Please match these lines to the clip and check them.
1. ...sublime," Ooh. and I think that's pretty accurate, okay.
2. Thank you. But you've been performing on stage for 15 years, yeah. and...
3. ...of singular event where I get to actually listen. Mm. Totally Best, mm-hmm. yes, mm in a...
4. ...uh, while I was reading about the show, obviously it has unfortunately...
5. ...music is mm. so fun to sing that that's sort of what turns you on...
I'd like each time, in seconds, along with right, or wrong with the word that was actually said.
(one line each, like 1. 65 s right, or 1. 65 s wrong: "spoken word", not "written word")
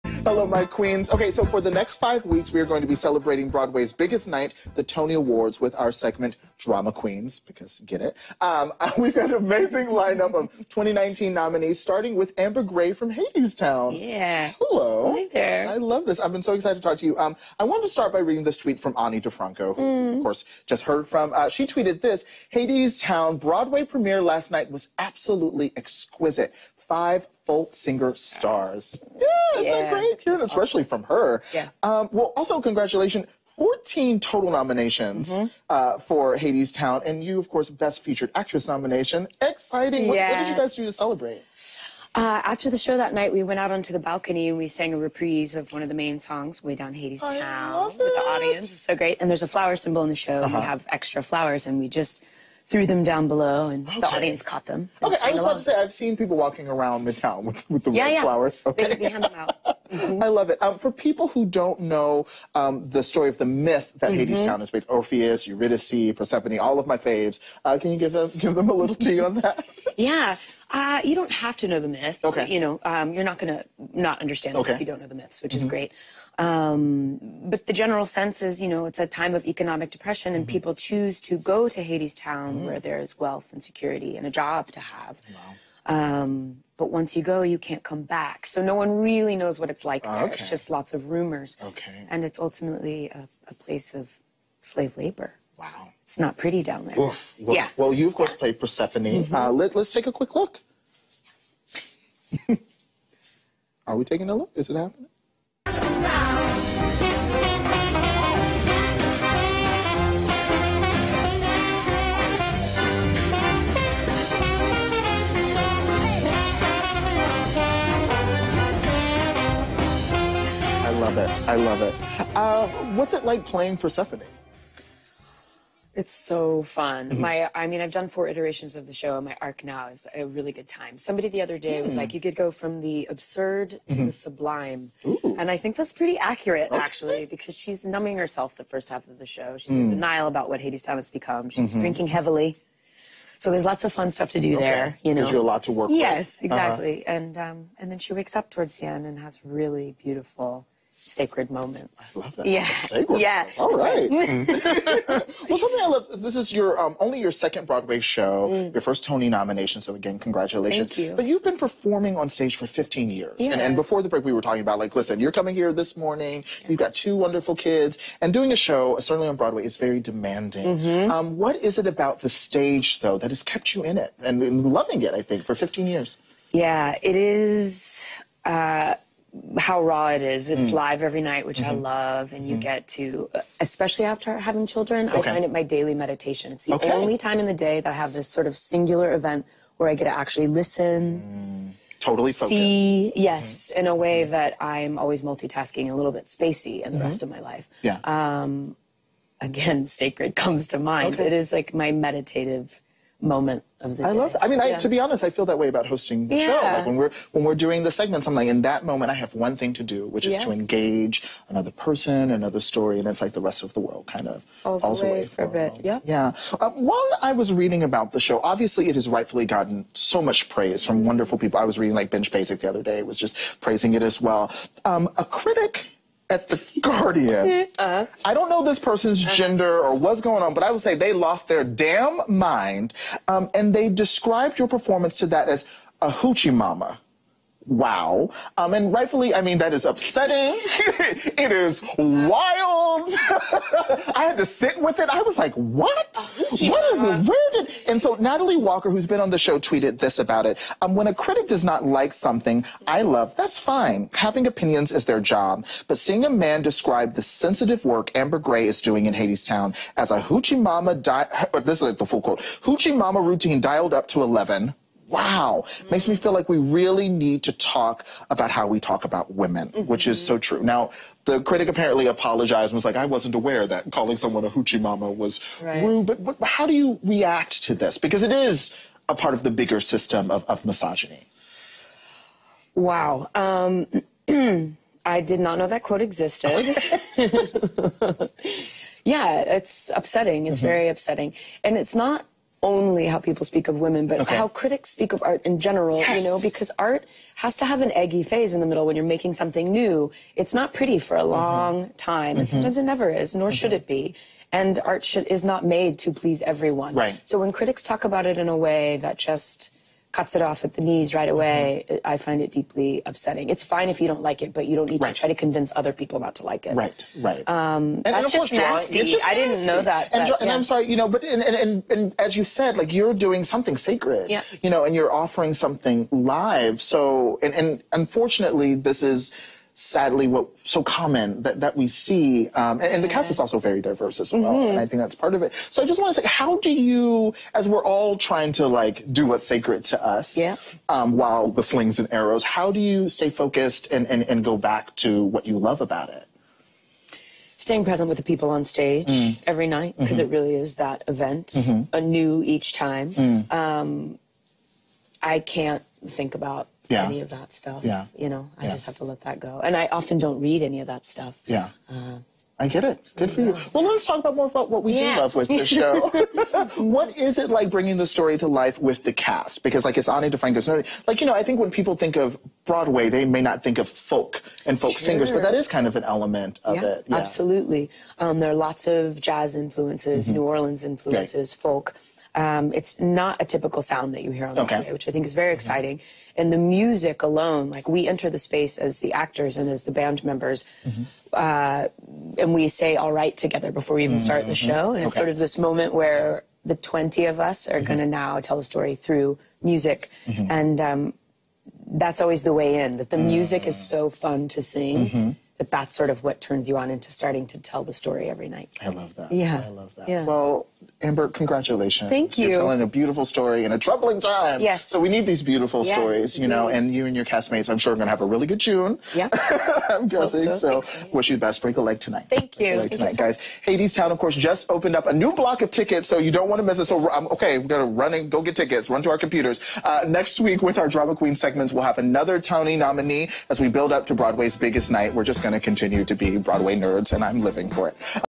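1. 134 s right
2. 160 s right
3. 188 s wrong: "See", not "Best"
4. 216 s wrong: "rightfully", not "unfortunately"
5. 403 s right.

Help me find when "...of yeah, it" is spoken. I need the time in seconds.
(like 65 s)
376 s.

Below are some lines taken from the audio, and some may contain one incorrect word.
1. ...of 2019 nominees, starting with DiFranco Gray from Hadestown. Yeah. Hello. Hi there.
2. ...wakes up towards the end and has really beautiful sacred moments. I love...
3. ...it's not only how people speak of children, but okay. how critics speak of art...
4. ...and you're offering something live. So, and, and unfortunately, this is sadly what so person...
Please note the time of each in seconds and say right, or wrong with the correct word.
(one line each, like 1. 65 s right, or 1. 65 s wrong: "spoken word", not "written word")
1. 10 s wrong: "Amber", not "DiFranco"
2. 148 s right
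3. 291 s wrong: "women", not "children"
4. 324 s wrong: "common", not "person".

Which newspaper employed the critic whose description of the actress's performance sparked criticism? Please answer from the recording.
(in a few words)
the Guardian.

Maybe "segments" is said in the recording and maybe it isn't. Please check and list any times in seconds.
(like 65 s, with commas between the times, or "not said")
5 s, 207 s, 431 s.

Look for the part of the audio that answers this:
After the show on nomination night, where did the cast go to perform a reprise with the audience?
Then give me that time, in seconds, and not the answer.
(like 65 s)
43 s.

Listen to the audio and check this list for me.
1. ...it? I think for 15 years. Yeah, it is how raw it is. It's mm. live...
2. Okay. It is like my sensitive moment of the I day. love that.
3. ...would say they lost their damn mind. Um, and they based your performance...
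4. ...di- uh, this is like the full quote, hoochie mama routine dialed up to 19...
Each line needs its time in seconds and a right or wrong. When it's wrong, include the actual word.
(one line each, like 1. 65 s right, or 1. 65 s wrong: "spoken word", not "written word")
1. 175 s right
2. 201 s wrong: "meditative", not "sensitive"
3. 230 s wrong: "described", not "based"
4. 260 s wrong: "11", not "19".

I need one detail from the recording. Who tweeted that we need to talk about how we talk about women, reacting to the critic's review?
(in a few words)
Natalie Walker.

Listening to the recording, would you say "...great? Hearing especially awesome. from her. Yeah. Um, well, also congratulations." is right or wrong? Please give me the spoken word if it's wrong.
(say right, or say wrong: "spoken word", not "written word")
right.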